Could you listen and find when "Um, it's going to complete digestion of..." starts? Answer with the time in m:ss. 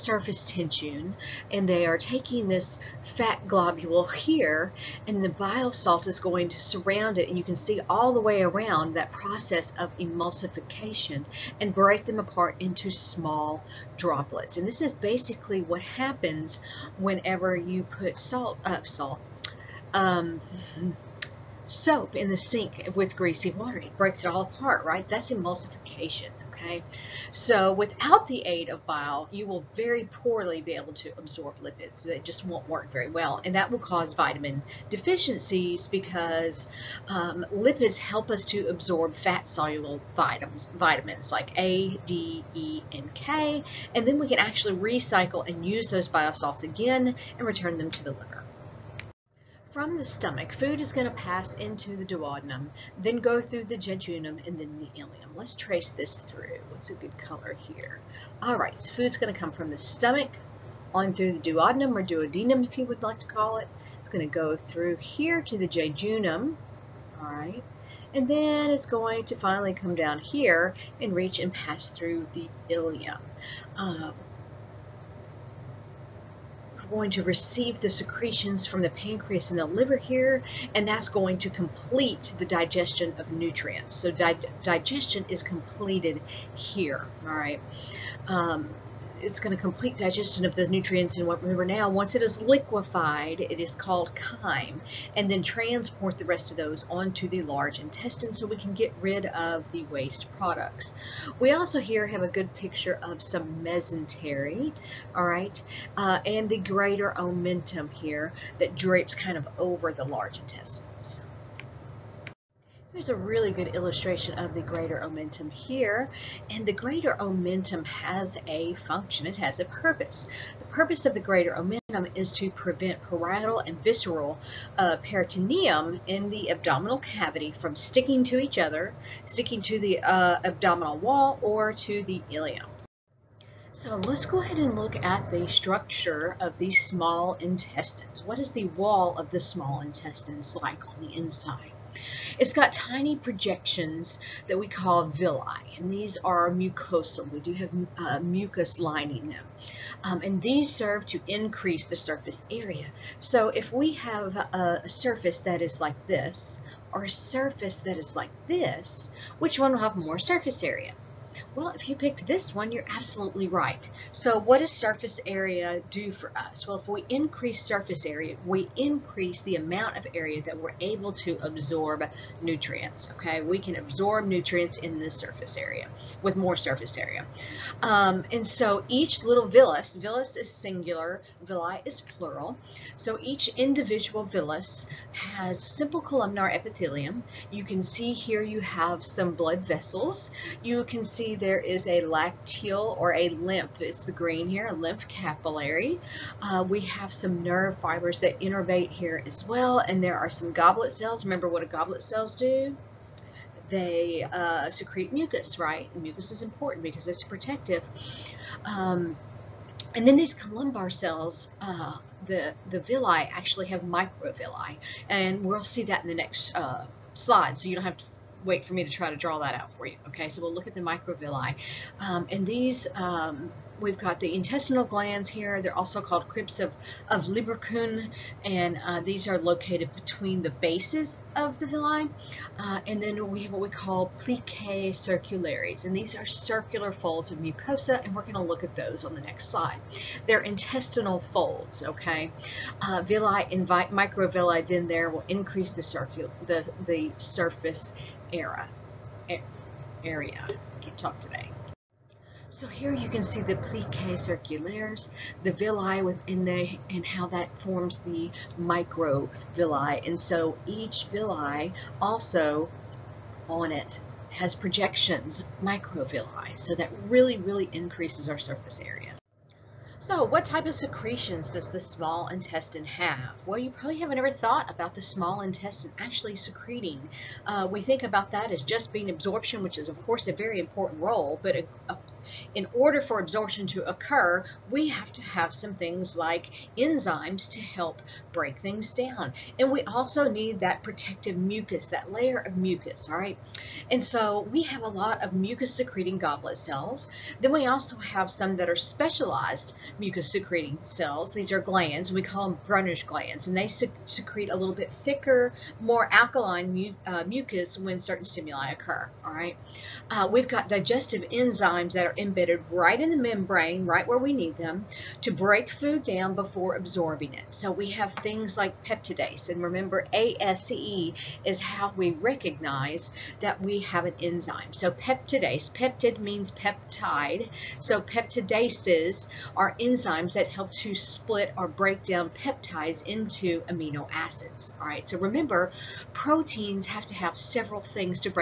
1:28.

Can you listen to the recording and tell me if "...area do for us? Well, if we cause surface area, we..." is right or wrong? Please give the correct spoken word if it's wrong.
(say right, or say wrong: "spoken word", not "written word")
wrong: "increase", not "cause".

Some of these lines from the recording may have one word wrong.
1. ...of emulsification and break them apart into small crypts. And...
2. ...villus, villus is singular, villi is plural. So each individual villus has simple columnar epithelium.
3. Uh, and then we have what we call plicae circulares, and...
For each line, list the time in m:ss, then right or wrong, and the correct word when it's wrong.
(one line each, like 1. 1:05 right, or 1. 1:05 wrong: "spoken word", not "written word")
1. 0:09 wrong: "droplets", not "crypts"
2. 2:59 right
3. 3:52 right.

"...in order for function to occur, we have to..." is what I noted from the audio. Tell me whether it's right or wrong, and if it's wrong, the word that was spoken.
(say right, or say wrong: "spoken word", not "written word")
wrong: "absorption", not "function".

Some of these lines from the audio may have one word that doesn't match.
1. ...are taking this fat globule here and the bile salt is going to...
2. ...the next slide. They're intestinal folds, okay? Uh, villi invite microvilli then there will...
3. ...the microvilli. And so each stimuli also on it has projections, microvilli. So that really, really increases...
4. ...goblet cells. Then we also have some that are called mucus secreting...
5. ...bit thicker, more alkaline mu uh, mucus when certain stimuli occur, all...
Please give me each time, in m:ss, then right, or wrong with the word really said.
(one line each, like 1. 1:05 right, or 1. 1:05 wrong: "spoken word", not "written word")
1. 0:01 right
2. 3:59 right
3. 4:17 wrong: "villi", not "stimuli"
4. 4:56 wrong: "specialized", not "called"
5. 5:04 right.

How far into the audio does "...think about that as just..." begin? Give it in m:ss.
4:37.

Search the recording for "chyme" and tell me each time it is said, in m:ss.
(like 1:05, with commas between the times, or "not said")
1:34.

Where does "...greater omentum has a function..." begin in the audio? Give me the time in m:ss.
1:56.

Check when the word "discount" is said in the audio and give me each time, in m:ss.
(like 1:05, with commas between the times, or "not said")
not said.